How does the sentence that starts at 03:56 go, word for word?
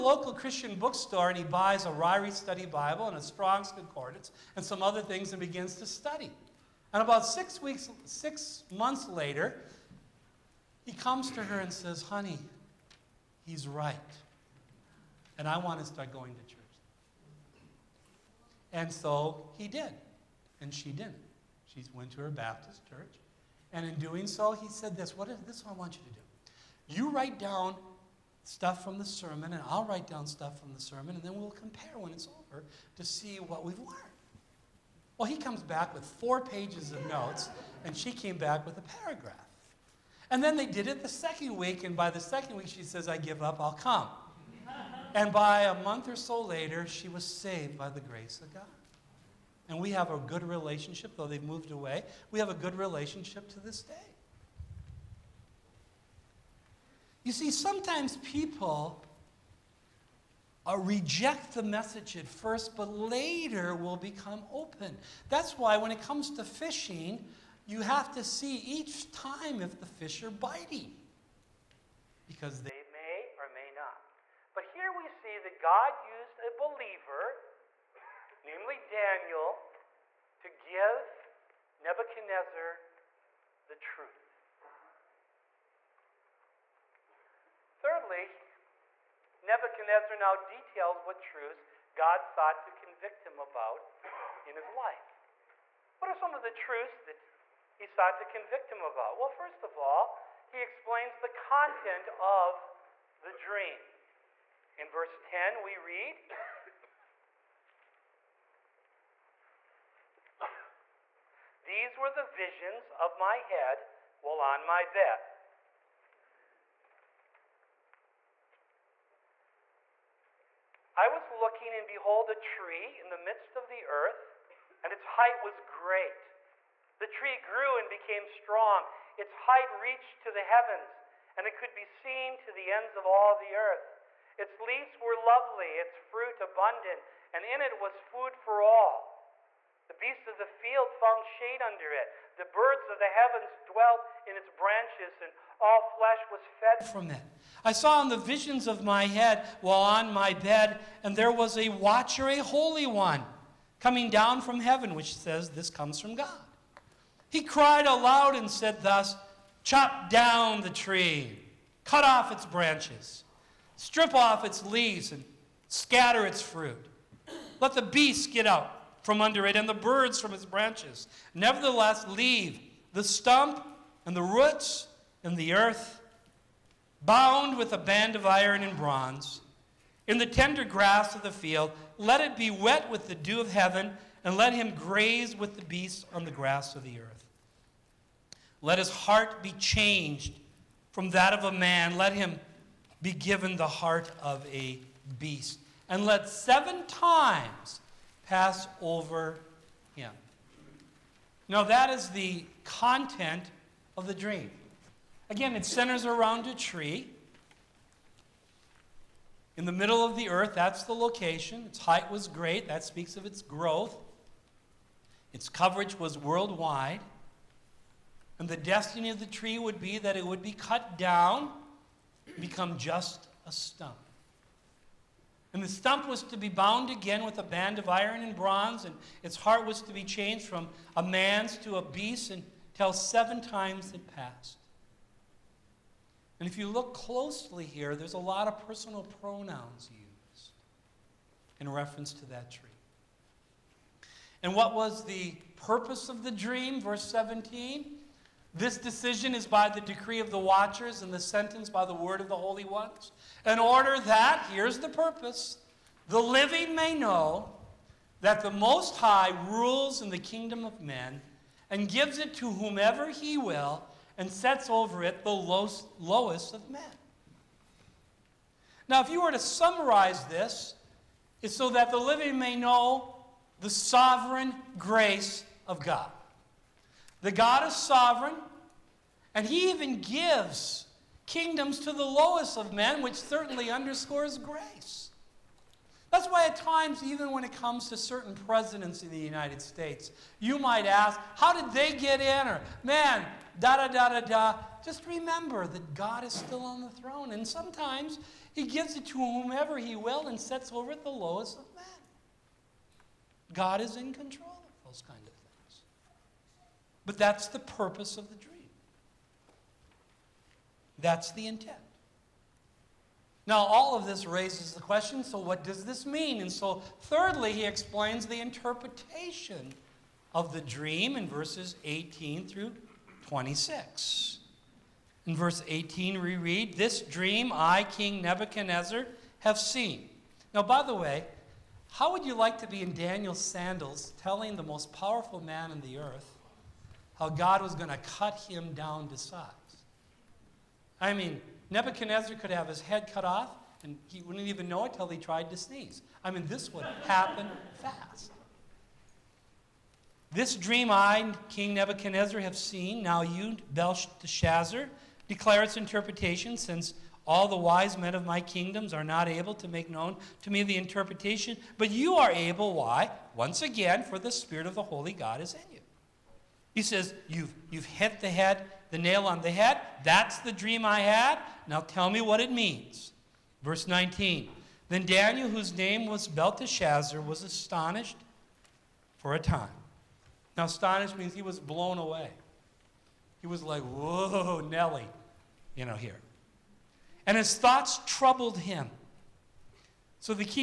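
And if you look closely here, there's a lot of personal pronouns used in reference to that tree.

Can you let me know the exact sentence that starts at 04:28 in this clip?
Now, if you were to summarize this, it's so that the living may know the sovereign grace of God.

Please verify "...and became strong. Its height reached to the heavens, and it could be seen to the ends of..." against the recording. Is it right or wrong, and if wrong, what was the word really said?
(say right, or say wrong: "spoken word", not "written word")
right.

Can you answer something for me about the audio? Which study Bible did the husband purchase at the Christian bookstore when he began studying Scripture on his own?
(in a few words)
Ryrie Study Bible.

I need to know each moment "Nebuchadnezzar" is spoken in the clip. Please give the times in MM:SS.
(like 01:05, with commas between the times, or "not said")
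01:21, 01:29, 05:28, 05:41, 05:51.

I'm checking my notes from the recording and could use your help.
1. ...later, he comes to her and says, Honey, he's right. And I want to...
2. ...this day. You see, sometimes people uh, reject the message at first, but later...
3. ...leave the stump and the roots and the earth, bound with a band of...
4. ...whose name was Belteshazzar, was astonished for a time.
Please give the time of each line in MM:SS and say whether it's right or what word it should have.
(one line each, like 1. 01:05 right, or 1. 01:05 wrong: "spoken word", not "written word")
1. 00:09 right
2. 00:53 right
3. 02:52 right
4. 06:15 right.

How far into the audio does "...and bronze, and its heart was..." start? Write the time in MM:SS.
03:48.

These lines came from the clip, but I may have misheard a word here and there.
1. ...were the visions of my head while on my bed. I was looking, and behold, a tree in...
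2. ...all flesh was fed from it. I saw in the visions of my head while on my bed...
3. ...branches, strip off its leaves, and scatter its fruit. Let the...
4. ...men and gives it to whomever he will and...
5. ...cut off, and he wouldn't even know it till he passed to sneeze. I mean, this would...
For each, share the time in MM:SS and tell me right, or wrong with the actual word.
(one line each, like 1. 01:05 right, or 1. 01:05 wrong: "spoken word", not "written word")
1. 01:51 right
2. 02:25 right
3. 02:42 right
4. 04:20 right
5. 05:43 wrong: "tried", not "passed".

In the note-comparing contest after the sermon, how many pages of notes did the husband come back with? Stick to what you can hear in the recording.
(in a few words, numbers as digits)
4.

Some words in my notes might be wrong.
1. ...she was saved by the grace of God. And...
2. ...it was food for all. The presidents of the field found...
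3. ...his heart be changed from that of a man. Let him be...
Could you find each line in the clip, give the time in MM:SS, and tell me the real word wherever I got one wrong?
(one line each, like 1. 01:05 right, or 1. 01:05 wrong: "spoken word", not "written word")
1. 00:46 right
2. 02:17 wrong: "beasts", not "presidents"
3. 03:08 right.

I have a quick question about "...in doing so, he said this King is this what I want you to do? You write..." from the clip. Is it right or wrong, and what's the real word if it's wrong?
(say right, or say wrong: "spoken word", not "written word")
wrong: "What", not "King".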